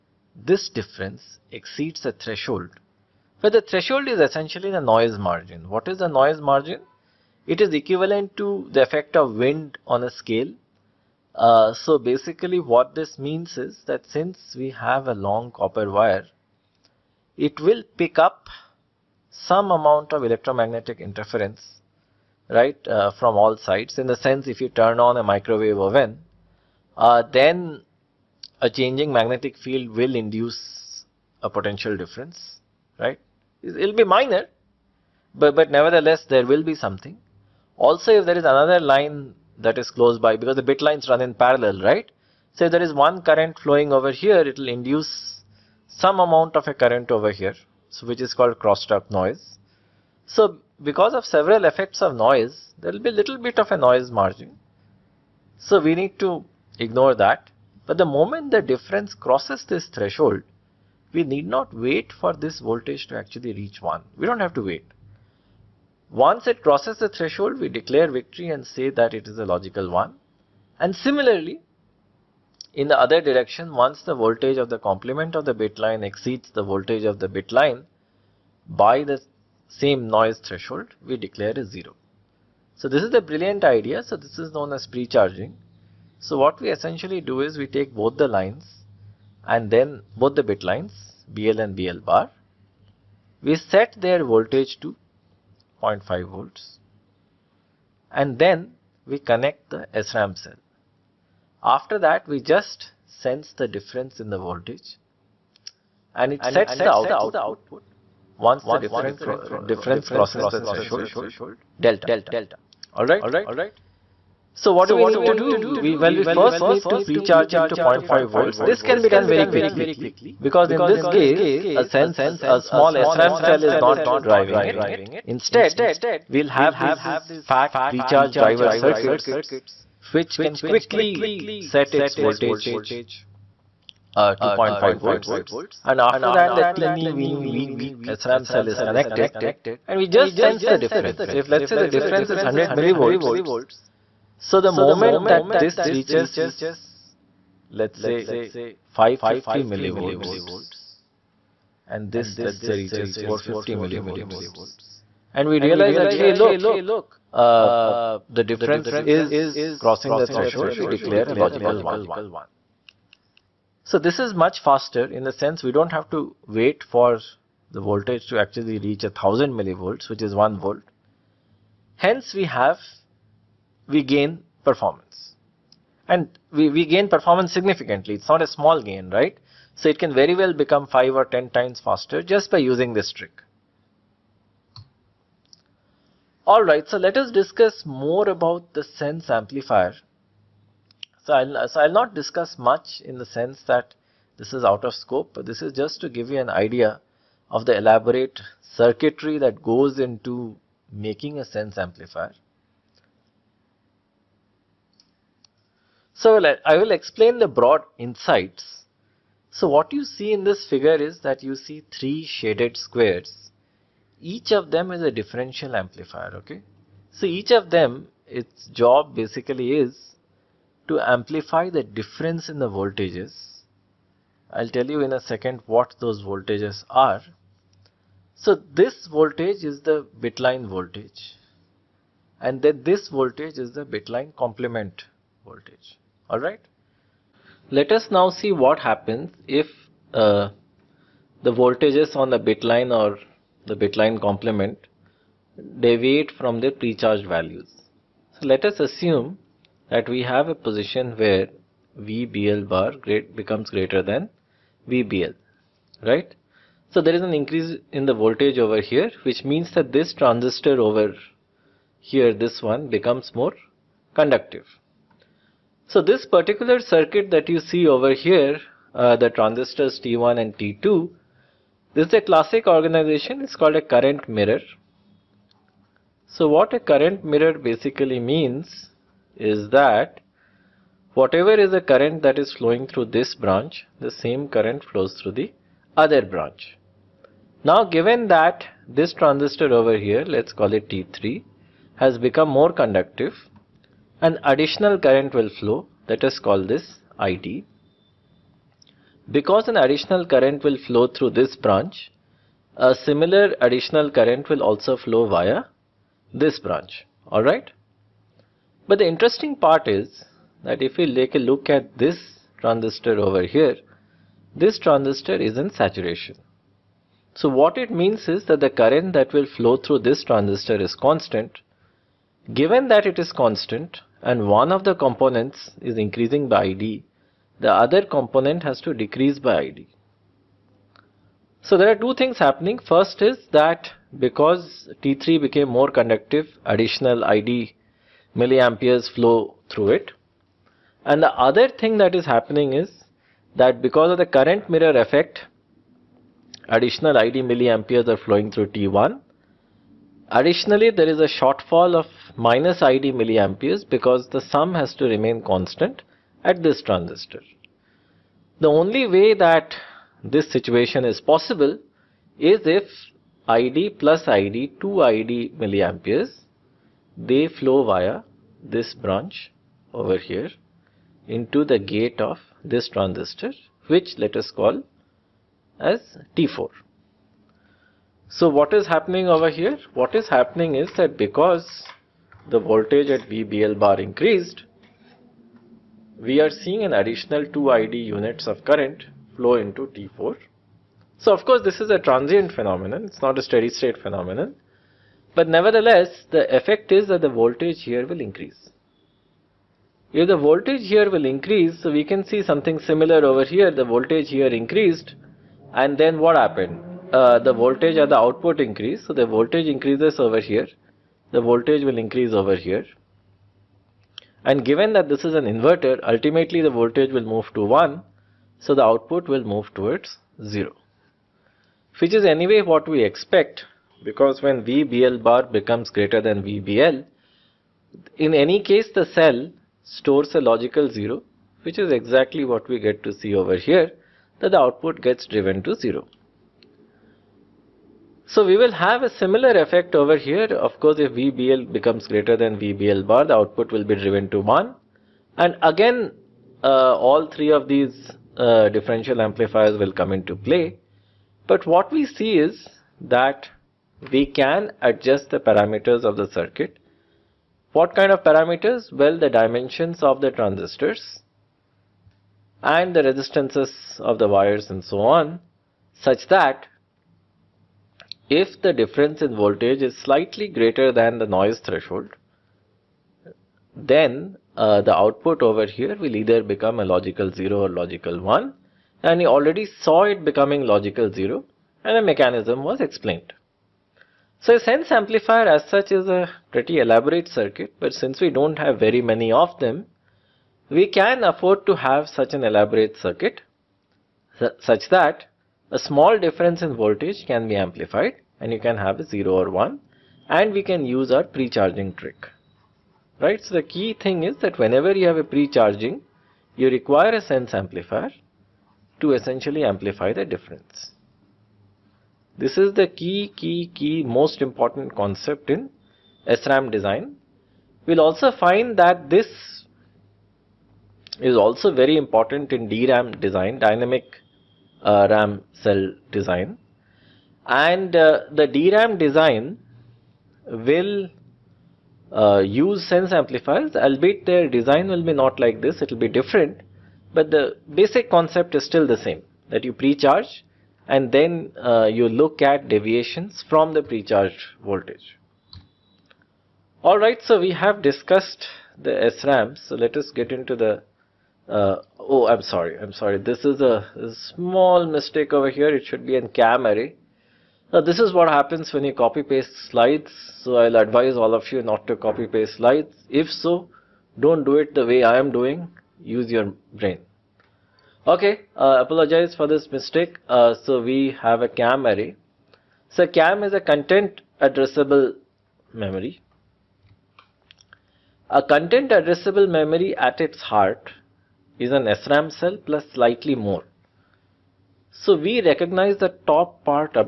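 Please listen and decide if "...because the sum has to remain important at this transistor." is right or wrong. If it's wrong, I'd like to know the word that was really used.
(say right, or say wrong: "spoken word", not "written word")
wrong: "constant", not "important".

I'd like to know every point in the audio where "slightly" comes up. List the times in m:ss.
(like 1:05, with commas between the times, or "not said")
7:49, 9:42.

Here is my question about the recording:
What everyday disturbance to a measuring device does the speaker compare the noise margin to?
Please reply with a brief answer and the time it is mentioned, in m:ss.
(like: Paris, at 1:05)
wind on a scale, at 0:09.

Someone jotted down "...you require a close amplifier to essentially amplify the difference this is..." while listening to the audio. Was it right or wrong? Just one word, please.
wrong.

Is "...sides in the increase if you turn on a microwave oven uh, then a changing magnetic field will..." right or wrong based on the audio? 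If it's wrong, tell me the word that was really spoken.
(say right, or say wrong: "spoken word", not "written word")
wrong: "sense", not "increase".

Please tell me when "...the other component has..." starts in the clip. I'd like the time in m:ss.
5:27.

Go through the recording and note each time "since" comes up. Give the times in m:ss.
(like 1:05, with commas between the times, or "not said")
0:14, 8:07.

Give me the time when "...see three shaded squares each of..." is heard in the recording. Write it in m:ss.
3:31.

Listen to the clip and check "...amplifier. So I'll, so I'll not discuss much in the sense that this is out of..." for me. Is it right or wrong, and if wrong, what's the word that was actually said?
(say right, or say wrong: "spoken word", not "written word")
right.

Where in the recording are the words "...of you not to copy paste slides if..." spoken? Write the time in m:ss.
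9:21.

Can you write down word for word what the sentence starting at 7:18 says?
So we will have a similar effect over here.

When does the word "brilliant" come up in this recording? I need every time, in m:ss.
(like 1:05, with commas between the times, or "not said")
1:23.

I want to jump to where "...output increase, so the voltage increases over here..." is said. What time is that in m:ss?
6:48.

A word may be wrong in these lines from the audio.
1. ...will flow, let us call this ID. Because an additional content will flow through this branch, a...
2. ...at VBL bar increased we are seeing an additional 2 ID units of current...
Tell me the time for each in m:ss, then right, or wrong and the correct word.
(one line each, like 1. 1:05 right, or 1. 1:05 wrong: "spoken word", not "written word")
1. 4:55 wrong: "current", not "content"
2. 6:23 right.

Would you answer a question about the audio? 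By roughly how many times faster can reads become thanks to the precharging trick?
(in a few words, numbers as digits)
5 or 10 times.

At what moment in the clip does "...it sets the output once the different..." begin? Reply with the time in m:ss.
1:46.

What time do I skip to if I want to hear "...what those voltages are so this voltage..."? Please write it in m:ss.
3:45.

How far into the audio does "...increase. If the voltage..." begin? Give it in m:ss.
6:38.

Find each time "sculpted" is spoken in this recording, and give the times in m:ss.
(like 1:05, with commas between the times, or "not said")
not said.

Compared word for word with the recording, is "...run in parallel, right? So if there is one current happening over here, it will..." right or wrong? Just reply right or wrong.
wrong.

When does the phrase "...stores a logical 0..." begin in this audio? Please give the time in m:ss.
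7:09.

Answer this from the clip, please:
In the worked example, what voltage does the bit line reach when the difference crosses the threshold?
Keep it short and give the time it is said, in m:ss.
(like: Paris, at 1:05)
550 millivolts, at 2:28.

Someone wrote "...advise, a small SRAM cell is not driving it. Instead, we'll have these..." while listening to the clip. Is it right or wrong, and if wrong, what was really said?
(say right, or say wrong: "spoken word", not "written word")
wrong: "sense", not "advise".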